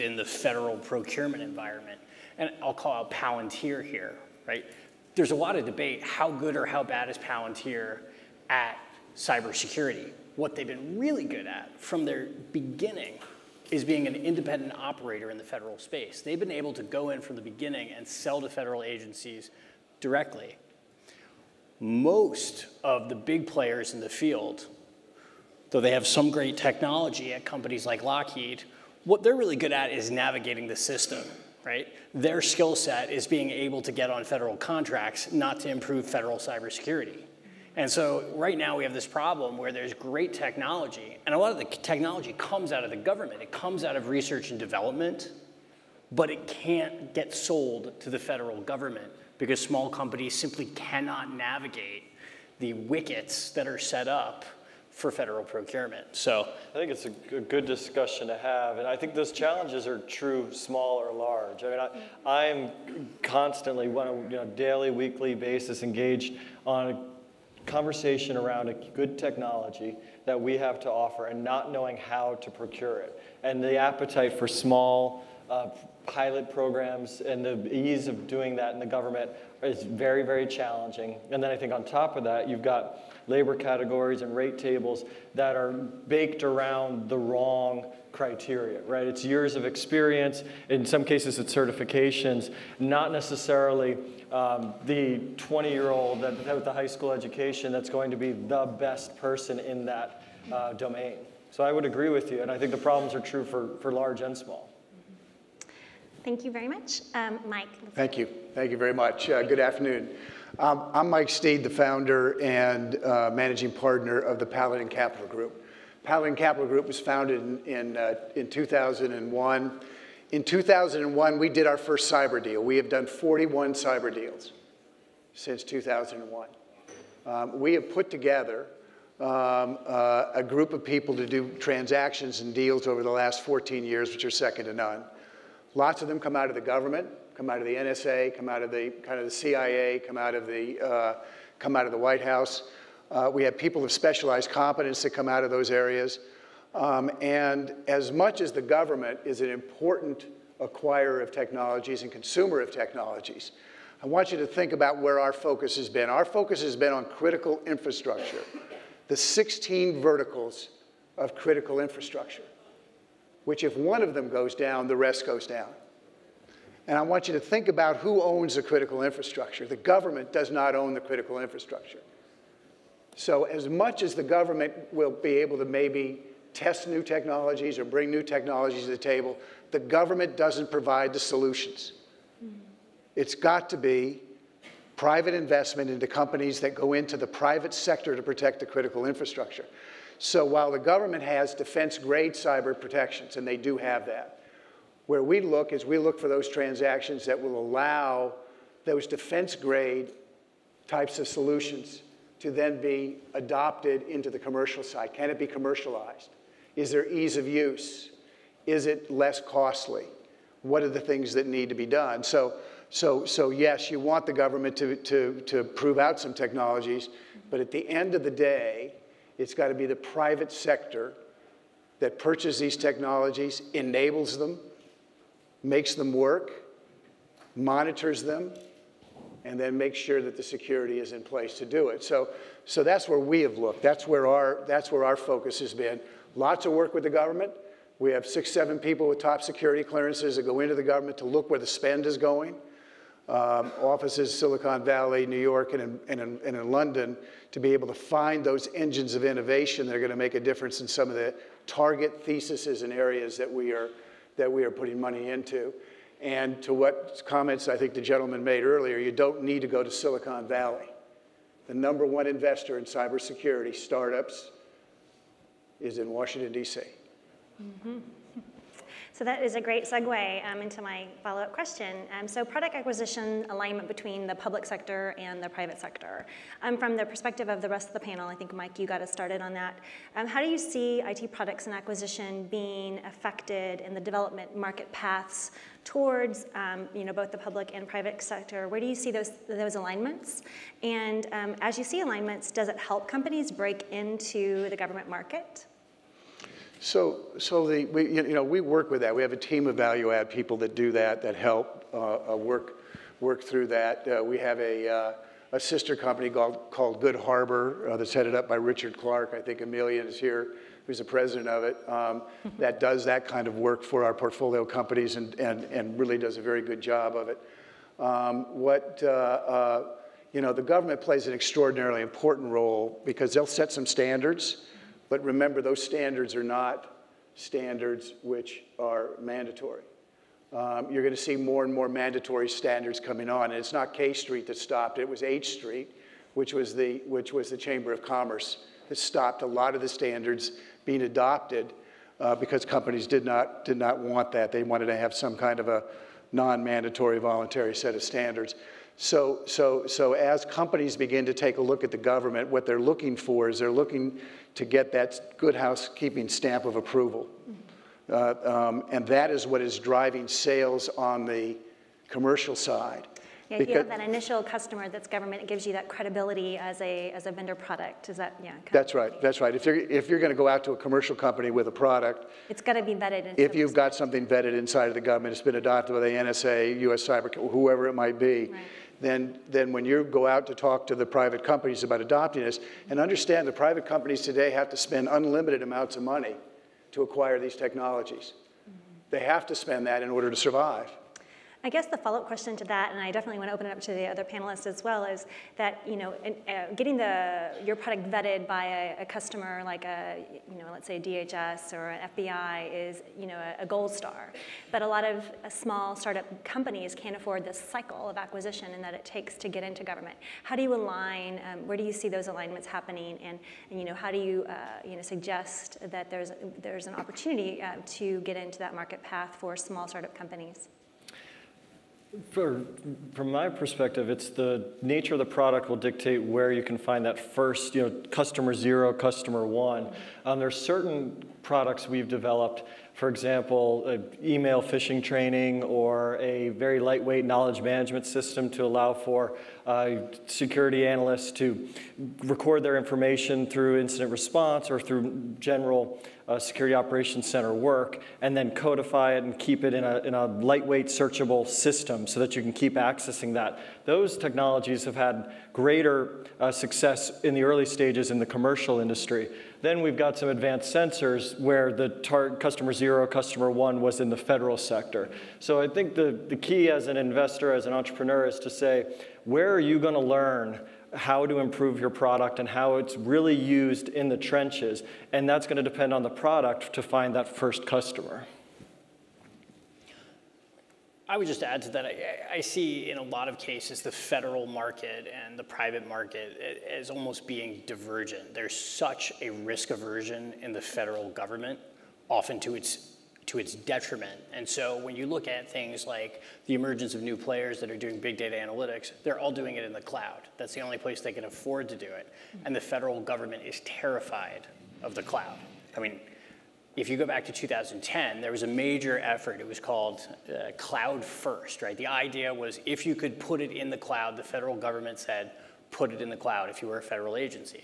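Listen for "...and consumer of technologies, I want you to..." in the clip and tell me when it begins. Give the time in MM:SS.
02:32.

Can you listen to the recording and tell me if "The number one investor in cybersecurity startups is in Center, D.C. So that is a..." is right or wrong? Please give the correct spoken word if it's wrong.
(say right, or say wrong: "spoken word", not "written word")
wrong: "Washington", not "Center".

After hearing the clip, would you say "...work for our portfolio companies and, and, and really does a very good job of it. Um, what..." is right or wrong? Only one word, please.
right.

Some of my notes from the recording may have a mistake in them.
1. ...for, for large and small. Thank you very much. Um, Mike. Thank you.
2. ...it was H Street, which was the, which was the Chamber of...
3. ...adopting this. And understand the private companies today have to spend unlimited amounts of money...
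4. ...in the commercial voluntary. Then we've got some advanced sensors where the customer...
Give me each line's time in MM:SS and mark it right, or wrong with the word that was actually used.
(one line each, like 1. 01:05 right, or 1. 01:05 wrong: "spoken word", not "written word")
1. 01:43 right
2. 05:34 right
3. 06:22 right
4. 07:38 wrong: "industry", not "voluntary".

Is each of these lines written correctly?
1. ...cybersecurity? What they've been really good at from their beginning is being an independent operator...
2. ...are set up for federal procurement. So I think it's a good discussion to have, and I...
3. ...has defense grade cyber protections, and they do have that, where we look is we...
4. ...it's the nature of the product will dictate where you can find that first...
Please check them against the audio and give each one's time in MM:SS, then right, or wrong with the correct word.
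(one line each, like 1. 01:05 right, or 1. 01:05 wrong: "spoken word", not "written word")
1. 00:09 right
2. 00:53 right
3. 03:11 right
4. 07:04 right.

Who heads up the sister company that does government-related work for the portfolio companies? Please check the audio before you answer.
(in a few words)
Richard Clarke.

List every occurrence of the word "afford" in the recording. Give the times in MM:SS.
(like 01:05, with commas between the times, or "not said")
06:47, 08:21.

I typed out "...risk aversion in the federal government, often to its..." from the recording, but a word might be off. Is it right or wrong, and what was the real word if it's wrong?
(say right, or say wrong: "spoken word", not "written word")
right.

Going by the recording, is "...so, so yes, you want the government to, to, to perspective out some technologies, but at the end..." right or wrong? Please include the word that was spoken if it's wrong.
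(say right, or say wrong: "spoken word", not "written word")
wrong: "prove", not "perspective".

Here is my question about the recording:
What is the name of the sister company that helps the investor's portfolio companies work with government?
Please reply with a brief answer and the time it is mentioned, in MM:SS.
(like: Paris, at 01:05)
Good Harbor, at 05:06.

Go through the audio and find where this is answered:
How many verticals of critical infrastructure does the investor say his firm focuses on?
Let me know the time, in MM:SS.
02:39.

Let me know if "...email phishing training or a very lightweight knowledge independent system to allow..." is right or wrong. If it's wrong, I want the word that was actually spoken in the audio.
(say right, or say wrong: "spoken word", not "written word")
wrong: "management", not "independent".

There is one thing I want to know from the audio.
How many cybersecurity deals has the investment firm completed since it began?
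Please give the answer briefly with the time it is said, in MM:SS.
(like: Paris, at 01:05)
41, at 02:03.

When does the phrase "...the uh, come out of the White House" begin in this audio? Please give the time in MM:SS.
02:20.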